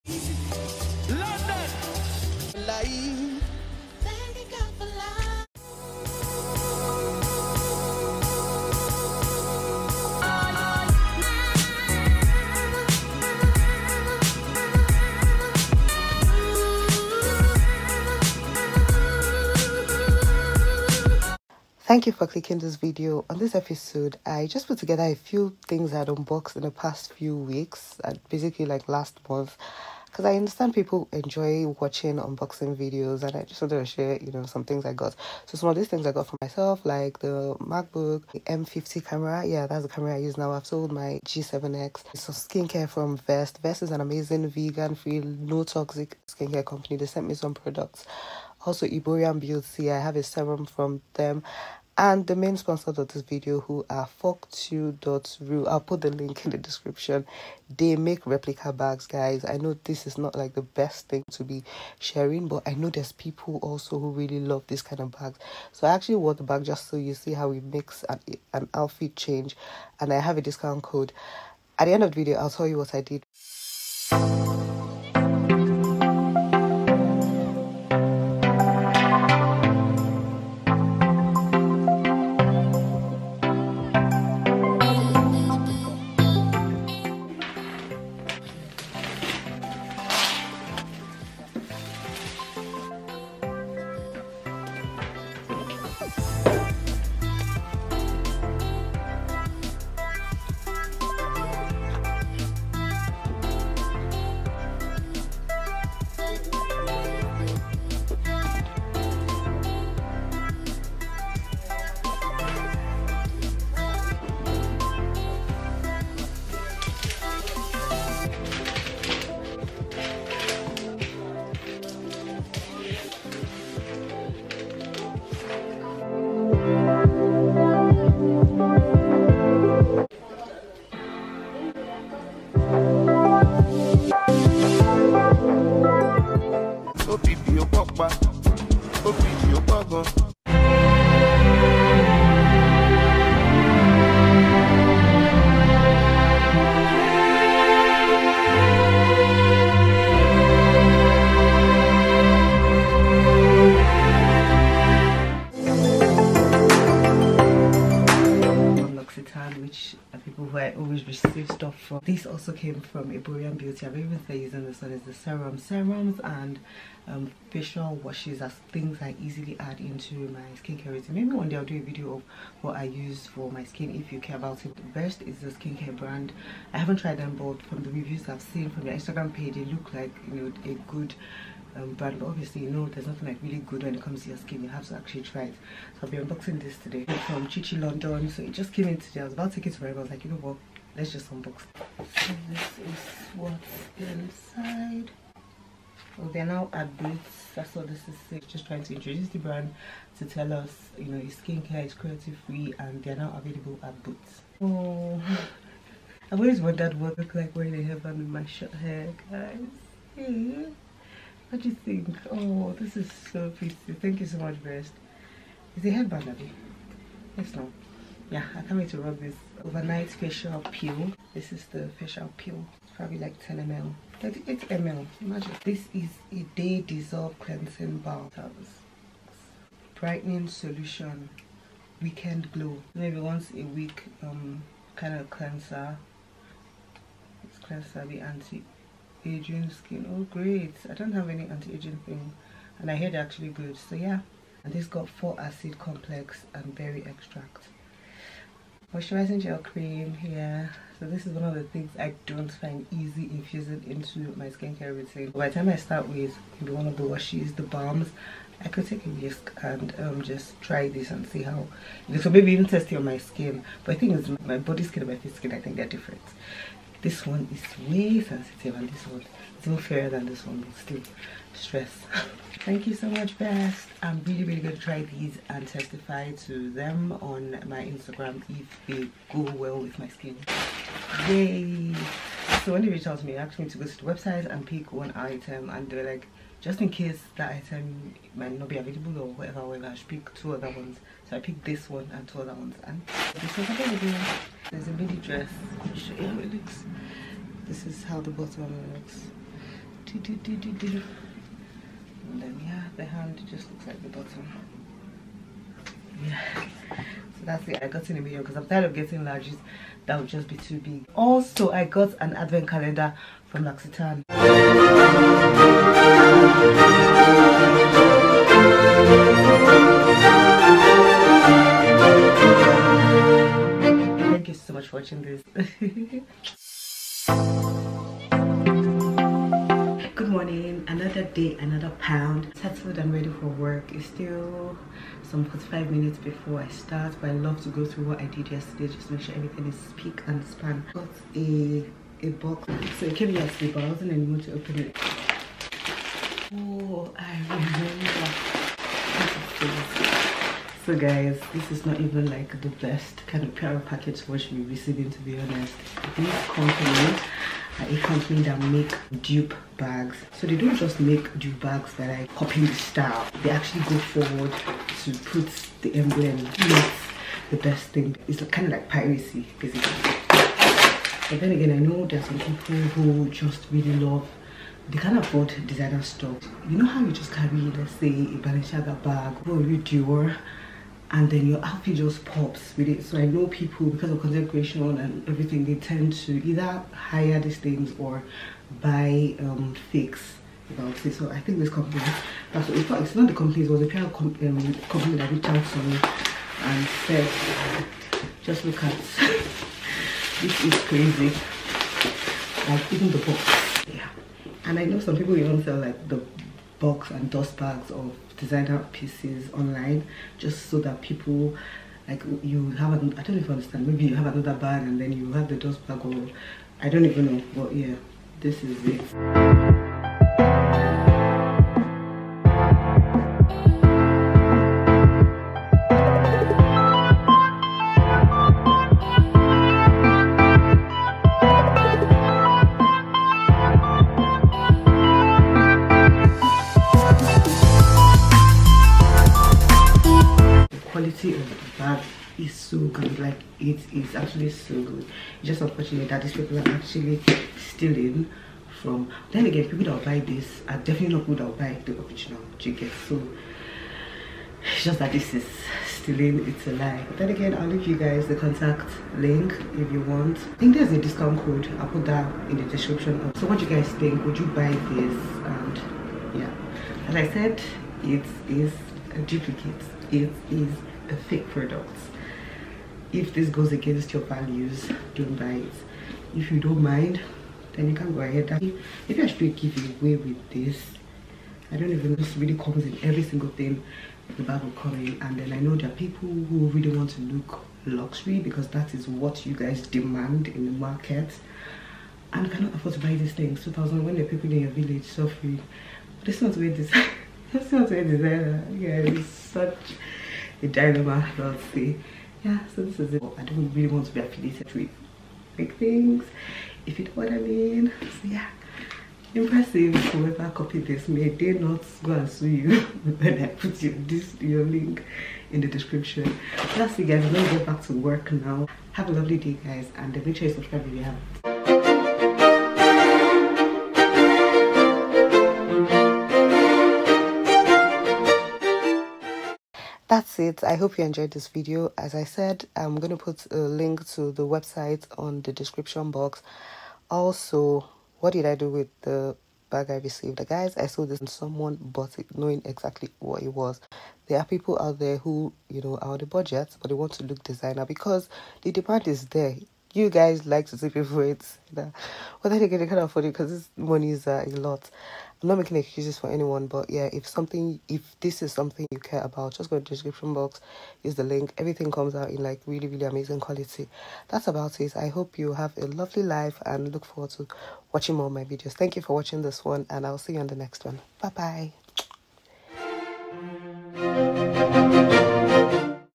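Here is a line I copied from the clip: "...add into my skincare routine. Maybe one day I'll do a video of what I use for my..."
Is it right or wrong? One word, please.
right.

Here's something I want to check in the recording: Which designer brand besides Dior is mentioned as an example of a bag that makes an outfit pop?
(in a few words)
Balenciaga.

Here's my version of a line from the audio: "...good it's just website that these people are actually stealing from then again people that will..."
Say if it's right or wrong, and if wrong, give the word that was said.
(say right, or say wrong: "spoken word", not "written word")
wrong: "unfortunate", not "website".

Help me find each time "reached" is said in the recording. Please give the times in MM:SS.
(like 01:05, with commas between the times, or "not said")
04:42, 06:35.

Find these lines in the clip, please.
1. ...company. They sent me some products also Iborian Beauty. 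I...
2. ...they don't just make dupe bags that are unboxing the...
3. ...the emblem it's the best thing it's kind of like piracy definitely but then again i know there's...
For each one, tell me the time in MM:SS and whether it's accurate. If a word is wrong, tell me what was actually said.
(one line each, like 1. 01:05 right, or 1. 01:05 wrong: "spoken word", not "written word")
1. 00:46 right
2. 06:00 wrong: "copying", not "unboxing"
3. 06:05 wrong: "basically", not "definitely".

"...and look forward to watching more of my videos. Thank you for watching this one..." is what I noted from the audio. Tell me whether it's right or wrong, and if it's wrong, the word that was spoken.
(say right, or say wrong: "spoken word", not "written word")
right.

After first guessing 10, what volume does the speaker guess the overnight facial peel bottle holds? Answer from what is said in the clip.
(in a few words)
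38 ml.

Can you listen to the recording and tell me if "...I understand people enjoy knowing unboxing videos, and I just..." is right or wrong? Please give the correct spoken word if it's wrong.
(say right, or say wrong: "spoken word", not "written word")
wrong: "watching", not "knowing".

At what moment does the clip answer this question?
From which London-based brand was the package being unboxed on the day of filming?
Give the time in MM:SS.
03:07.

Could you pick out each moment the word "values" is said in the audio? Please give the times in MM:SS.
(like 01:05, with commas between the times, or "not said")
07:54.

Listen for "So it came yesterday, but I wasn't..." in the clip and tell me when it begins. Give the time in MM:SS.
05:42.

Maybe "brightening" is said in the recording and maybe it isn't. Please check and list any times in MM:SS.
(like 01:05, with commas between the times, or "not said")
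03:49.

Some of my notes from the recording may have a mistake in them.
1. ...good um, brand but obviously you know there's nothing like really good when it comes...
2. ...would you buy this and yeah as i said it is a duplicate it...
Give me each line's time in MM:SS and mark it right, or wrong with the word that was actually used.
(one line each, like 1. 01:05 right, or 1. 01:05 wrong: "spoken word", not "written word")
1. 03:00 right
2. 07:44 right.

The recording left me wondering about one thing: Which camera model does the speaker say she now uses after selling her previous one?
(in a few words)
M50.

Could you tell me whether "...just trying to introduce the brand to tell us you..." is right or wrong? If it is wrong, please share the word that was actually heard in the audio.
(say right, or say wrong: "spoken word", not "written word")
right.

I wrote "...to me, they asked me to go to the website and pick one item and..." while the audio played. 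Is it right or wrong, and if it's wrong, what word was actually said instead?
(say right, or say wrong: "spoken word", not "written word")
right.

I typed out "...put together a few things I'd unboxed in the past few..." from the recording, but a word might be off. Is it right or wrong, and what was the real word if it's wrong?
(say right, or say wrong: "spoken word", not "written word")
right.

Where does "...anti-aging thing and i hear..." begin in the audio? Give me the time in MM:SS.
04:01.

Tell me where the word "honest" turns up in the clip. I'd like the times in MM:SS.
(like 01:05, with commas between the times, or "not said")
05:55.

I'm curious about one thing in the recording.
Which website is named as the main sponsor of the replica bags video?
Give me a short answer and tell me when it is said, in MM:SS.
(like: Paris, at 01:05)
fortok.ru, at 00:54.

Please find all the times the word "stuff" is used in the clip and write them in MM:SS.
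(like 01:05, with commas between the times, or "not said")
02:41, 06:16.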